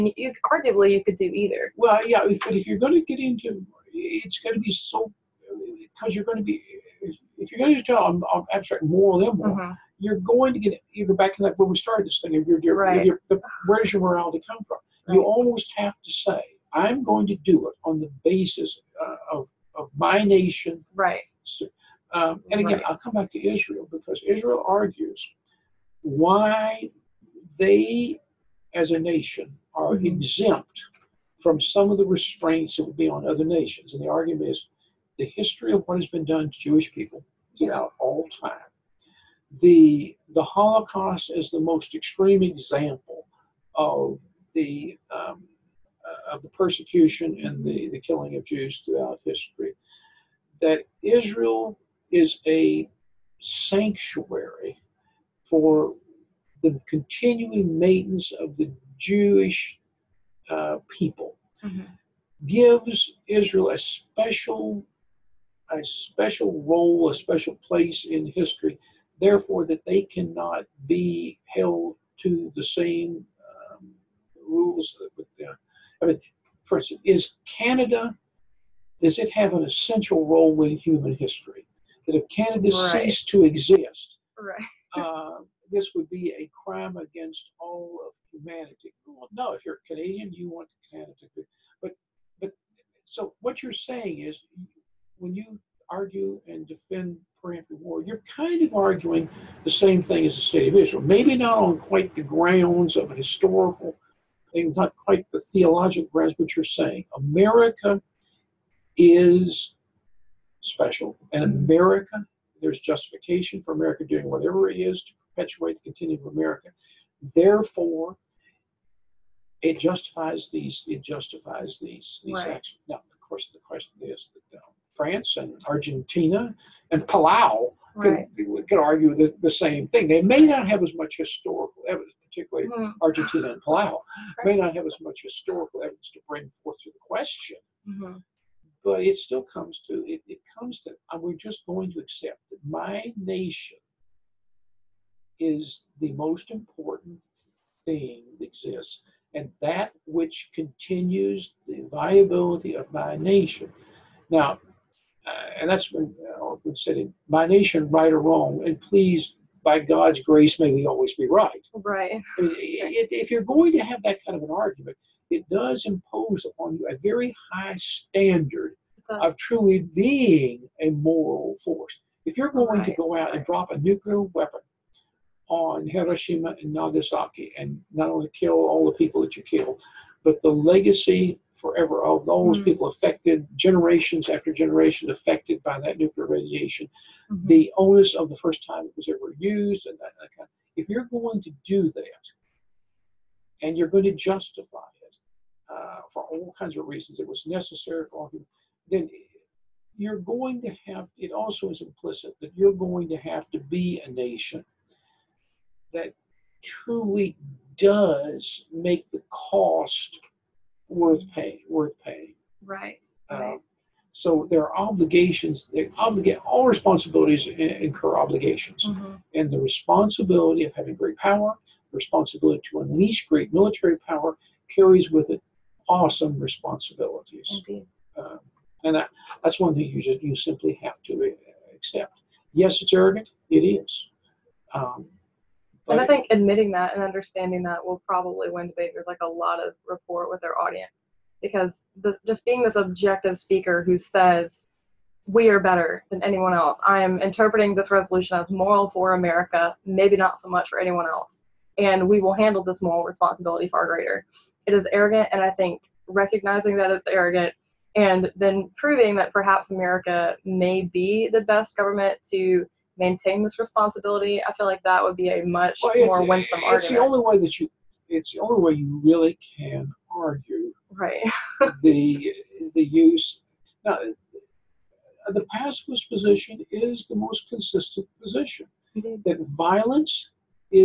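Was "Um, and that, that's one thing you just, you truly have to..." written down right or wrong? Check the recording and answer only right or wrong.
wrong.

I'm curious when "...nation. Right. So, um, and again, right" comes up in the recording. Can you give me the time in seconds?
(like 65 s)
20 s.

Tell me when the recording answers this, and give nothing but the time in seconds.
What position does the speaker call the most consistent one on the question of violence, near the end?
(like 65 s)
275 s.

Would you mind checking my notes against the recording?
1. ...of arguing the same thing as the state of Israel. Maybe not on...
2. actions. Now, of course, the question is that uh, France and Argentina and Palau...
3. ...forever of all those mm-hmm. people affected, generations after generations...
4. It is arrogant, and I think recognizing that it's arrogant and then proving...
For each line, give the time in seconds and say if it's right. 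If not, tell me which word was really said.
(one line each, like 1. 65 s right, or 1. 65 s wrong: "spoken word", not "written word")
1. 98 s right
2. 122 s right
3. 181 s right
4. 254 s right.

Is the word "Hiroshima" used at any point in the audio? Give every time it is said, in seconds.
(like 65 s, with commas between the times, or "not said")
175 s.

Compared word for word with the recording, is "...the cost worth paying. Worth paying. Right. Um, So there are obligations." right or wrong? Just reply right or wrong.
right.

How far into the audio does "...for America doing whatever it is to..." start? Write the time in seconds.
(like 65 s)
113 s.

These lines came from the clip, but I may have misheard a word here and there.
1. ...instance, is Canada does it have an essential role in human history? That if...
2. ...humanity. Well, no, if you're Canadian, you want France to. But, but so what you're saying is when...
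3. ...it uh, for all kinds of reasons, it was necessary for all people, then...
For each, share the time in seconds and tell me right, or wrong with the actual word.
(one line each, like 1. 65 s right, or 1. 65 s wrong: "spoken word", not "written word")
1. 76 s right
2. 88 s wrong: "Canada", not "France"
3. 195 s right.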